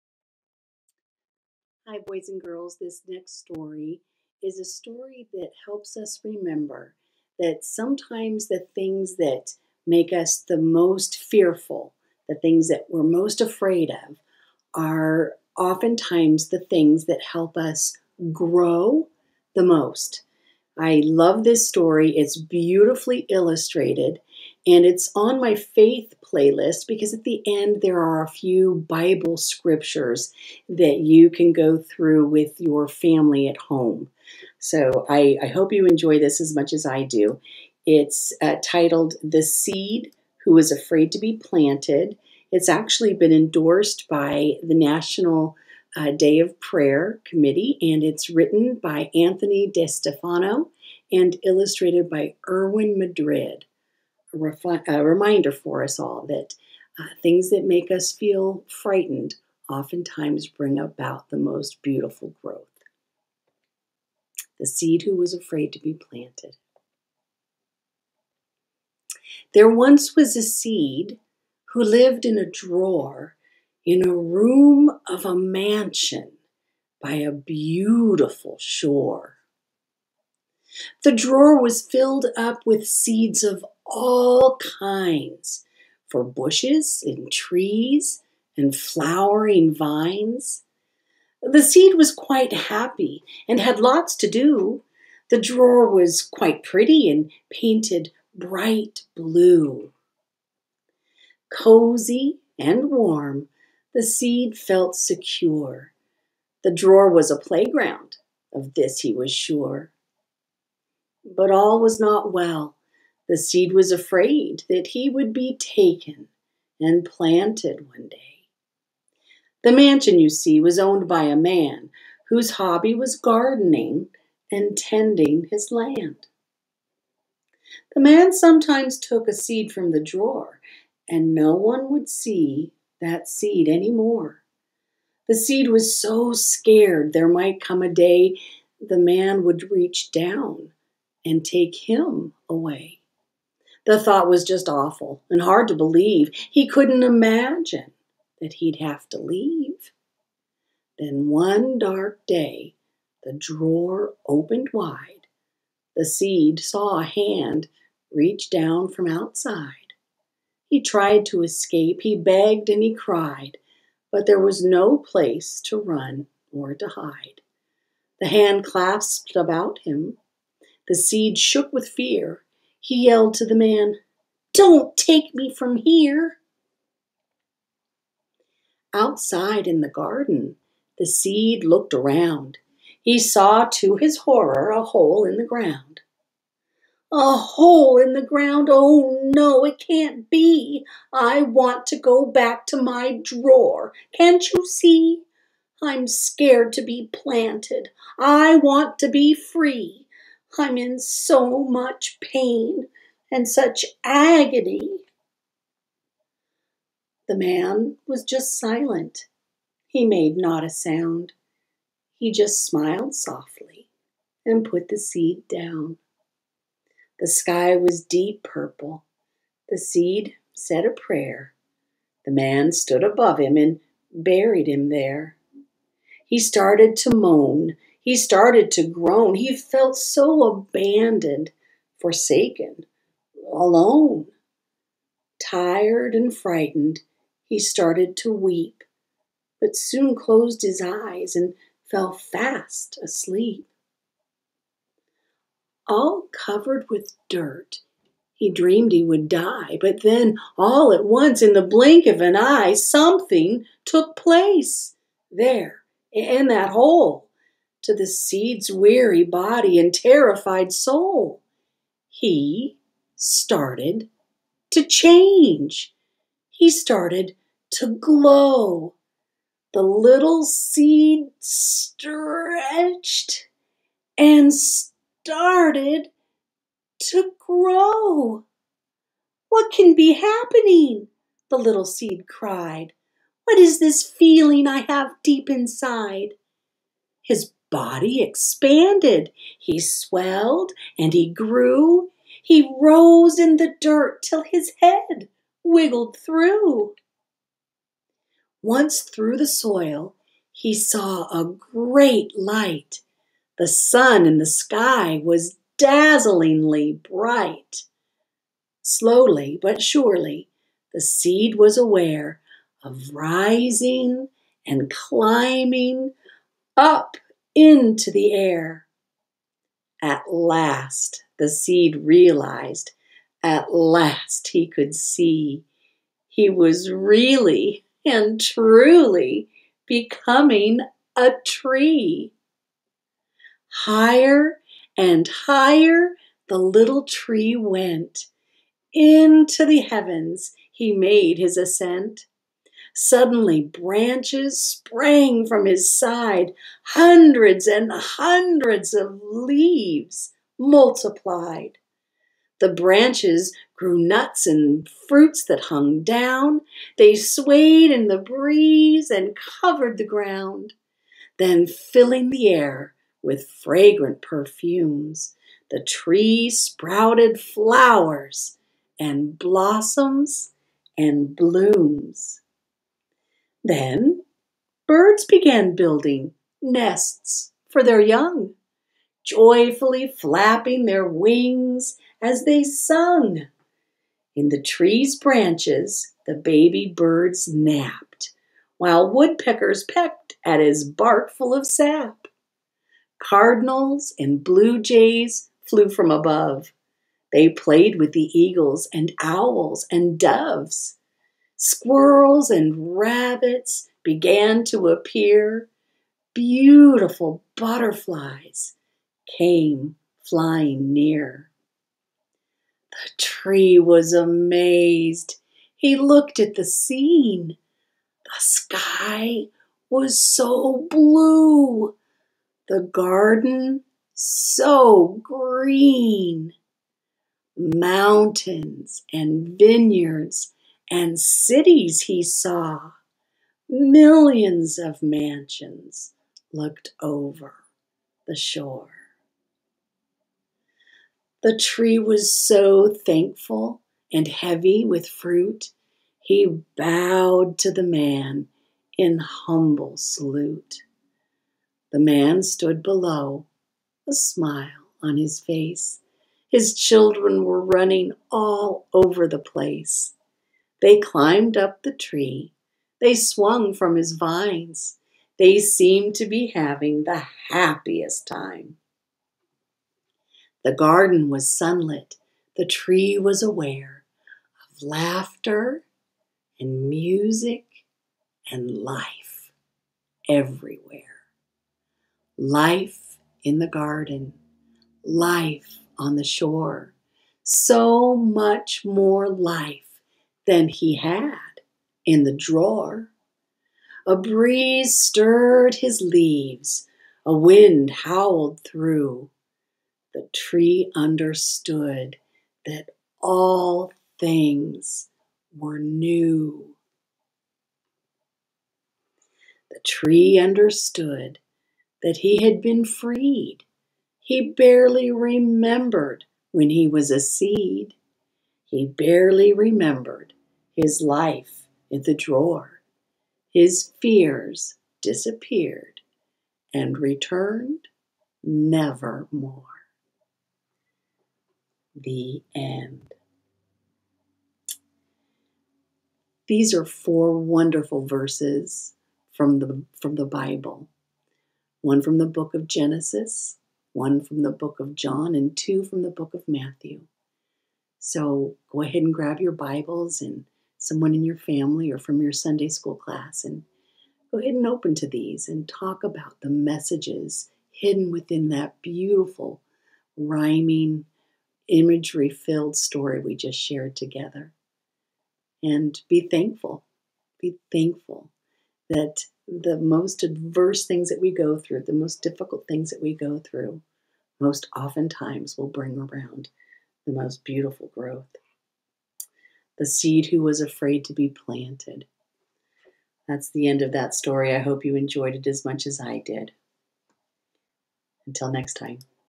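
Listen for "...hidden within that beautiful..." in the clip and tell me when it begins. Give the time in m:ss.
9:17.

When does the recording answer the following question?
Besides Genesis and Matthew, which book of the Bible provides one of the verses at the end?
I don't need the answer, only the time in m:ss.
9:04.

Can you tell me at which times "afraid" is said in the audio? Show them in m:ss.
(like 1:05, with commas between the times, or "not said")
0:13, 0:40, 1:05, 1:53, 9:40.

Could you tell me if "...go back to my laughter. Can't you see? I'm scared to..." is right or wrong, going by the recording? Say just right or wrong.
wrong.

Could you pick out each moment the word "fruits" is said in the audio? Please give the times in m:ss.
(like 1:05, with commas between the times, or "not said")
5:55, 7:25.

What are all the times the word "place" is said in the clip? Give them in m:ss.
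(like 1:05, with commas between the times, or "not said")
2:44, 4:14, 7:39.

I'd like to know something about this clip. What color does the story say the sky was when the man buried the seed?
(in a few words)
Deep purple.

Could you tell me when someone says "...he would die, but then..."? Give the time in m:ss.
4:08.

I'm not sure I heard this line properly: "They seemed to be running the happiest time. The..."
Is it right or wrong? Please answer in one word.
wrong.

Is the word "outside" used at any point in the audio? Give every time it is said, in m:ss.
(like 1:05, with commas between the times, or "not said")
2:39, 2:58.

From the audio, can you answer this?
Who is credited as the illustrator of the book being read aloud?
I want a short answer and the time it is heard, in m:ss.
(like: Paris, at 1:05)
Erwin Madrid, at 0:52.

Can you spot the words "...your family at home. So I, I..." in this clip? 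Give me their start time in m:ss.
0:32.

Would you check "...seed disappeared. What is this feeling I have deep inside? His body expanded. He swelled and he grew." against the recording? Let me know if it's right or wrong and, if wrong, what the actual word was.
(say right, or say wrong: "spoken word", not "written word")
wrong: "cried", not "disappeared".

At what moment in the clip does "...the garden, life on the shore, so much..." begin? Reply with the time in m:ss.
8:03.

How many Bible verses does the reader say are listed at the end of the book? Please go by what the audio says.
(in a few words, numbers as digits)
4.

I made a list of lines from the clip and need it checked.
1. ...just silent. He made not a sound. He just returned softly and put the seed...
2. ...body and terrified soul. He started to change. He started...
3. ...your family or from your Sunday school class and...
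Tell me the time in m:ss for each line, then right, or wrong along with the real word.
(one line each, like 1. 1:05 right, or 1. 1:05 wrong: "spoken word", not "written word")
1. 3:28 wrong: "smiled", not "returned"
2. 4:19 right
3. 9:11 right.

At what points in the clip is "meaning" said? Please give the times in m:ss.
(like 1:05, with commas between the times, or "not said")
not said.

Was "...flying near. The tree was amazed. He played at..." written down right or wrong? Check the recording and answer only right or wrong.
wrong.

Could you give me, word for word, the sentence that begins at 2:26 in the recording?
He couldn't imagine that he'd have to leave.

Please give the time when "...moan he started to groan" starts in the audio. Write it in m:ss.
3:47.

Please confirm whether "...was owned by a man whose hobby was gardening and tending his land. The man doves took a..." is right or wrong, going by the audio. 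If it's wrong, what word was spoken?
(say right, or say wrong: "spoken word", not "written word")
wrong: "sometimes", not "doves".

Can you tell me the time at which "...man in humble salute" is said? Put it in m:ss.
7:27.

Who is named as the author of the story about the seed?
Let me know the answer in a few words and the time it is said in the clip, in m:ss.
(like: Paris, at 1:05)
Anthony DeStefano, at 0:49.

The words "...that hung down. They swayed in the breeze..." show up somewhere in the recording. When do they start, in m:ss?
5:55.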